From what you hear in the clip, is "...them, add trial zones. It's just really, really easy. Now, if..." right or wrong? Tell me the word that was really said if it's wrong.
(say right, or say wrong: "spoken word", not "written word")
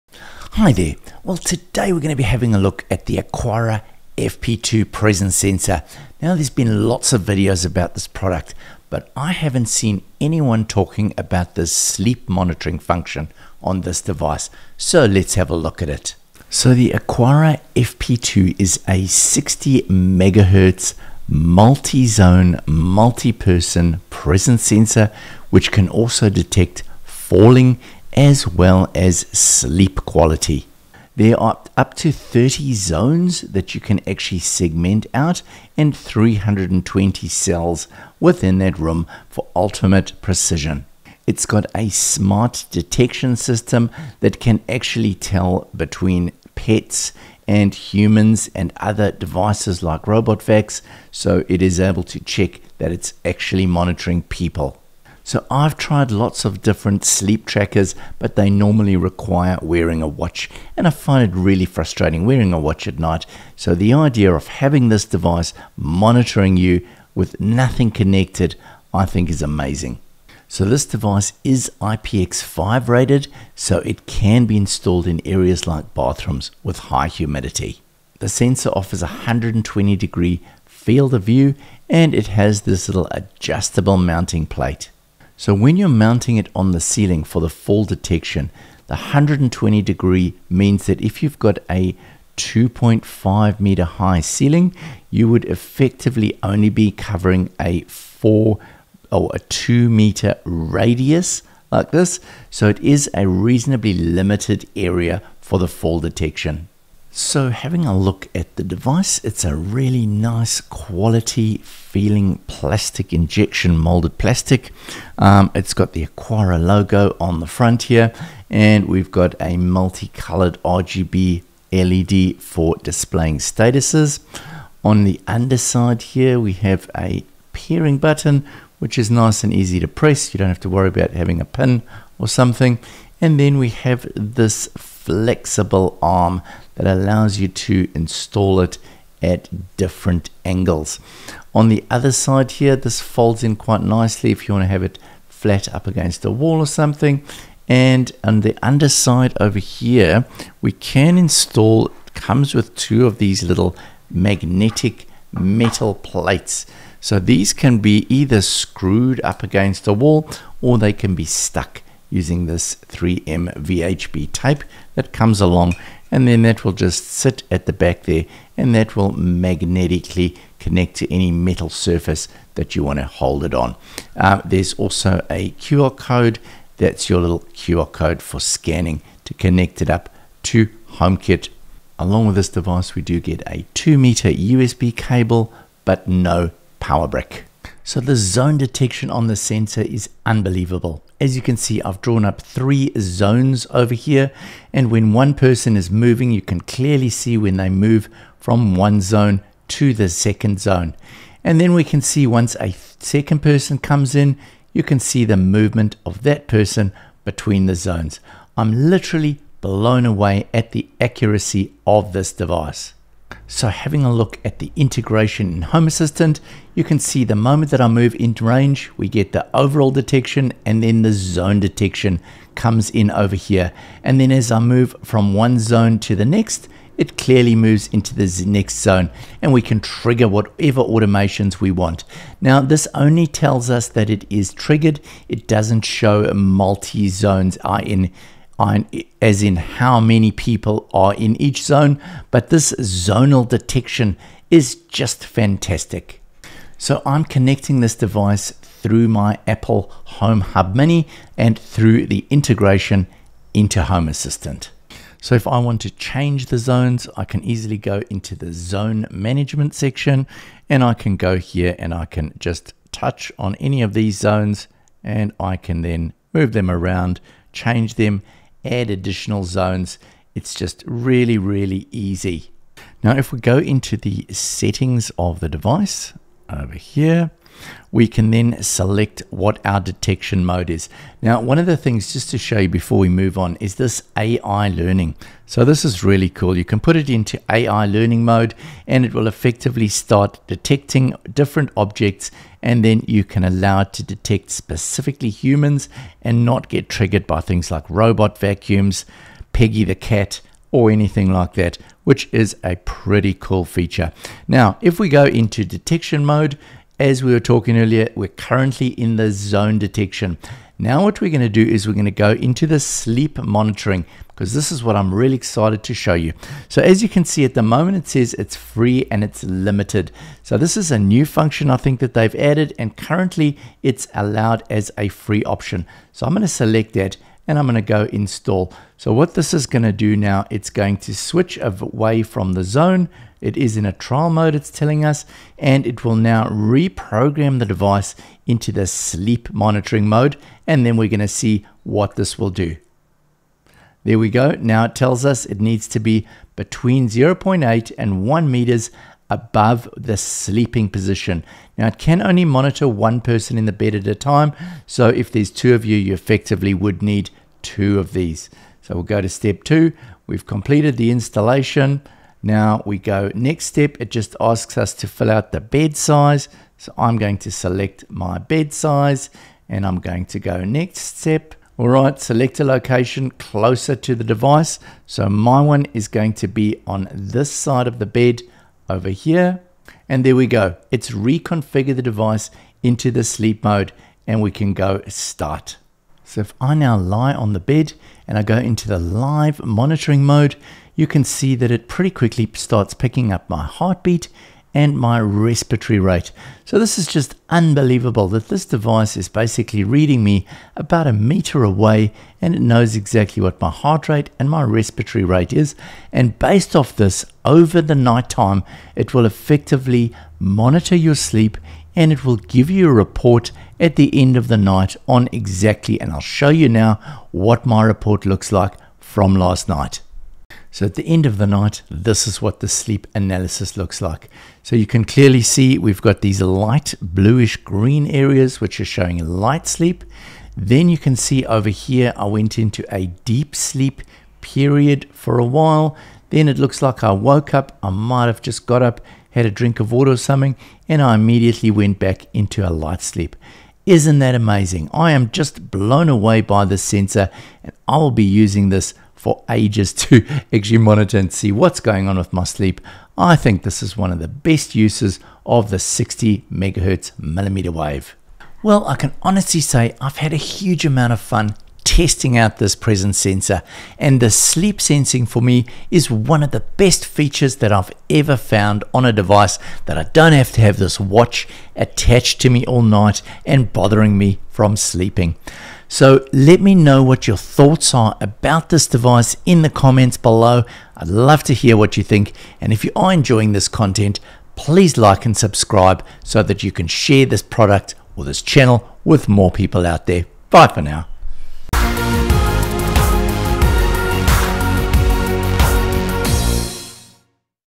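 wrong: "additional", not "trial".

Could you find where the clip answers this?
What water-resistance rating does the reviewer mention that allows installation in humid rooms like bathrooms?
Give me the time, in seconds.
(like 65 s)
71 s.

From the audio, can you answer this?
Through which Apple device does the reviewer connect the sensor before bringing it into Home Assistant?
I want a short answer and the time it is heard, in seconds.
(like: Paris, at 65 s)
Apple Home Hub Mini, at 249 s.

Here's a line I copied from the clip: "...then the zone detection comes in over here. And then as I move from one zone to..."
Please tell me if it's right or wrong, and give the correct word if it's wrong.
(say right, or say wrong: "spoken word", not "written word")
right.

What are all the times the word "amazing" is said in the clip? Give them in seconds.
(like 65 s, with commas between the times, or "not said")
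69 s, 444 s.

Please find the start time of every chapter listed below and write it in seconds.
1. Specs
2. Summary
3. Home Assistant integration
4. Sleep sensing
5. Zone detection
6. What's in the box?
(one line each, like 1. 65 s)
1. 18 s
2. 459 s
3. 213 s
4. 308 s
5. 188 s
6. 107 s.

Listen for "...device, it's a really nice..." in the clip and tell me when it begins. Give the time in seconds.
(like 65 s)
108 s.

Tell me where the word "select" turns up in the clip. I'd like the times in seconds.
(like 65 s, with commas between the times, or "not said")
278 s, 326 s, 367 s, 372 s.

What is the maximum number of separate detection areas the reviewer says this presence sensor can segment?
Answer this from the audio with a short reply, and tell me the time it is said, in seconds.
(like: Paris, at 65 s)
30, at 32 s.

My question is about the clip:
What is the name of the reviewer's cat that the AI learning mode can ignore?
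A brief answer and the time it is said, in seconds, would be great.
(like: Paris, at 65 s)
Peggy, at 299 s.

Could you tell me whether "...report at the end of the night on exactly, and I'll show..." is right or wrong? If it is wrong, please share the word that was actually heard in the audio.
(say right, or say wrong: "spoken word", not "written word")
right.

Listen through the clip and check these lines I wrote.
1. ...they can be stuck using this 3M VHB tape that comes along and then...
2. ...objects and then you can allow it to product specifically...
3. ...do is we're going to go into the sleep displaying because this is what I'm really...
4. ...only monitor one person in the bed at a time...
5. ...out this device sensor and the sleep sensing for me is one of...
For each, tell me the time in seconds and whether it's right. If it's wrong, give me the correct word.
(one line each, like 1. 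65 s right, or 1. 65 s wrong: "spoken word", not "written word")
1. 160 s right
2. 291 s wrong: "detect", not "product"
3. 311 s wrong: "monitoring", not "displaying"
4. 352 s right
5. 462 s wrong: "presence", not "device".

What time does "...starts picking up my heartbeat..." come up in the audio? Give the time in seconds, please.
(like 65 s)
392 s.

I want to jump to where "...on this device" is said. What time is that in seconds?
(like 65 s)
13 s.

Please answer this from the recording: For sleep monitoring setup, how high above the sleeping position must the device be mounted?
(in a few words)
0.8 to 1 meters.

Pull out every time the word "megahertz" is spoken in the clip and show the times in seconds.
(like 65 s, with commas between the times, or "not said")
19 s, 456 s.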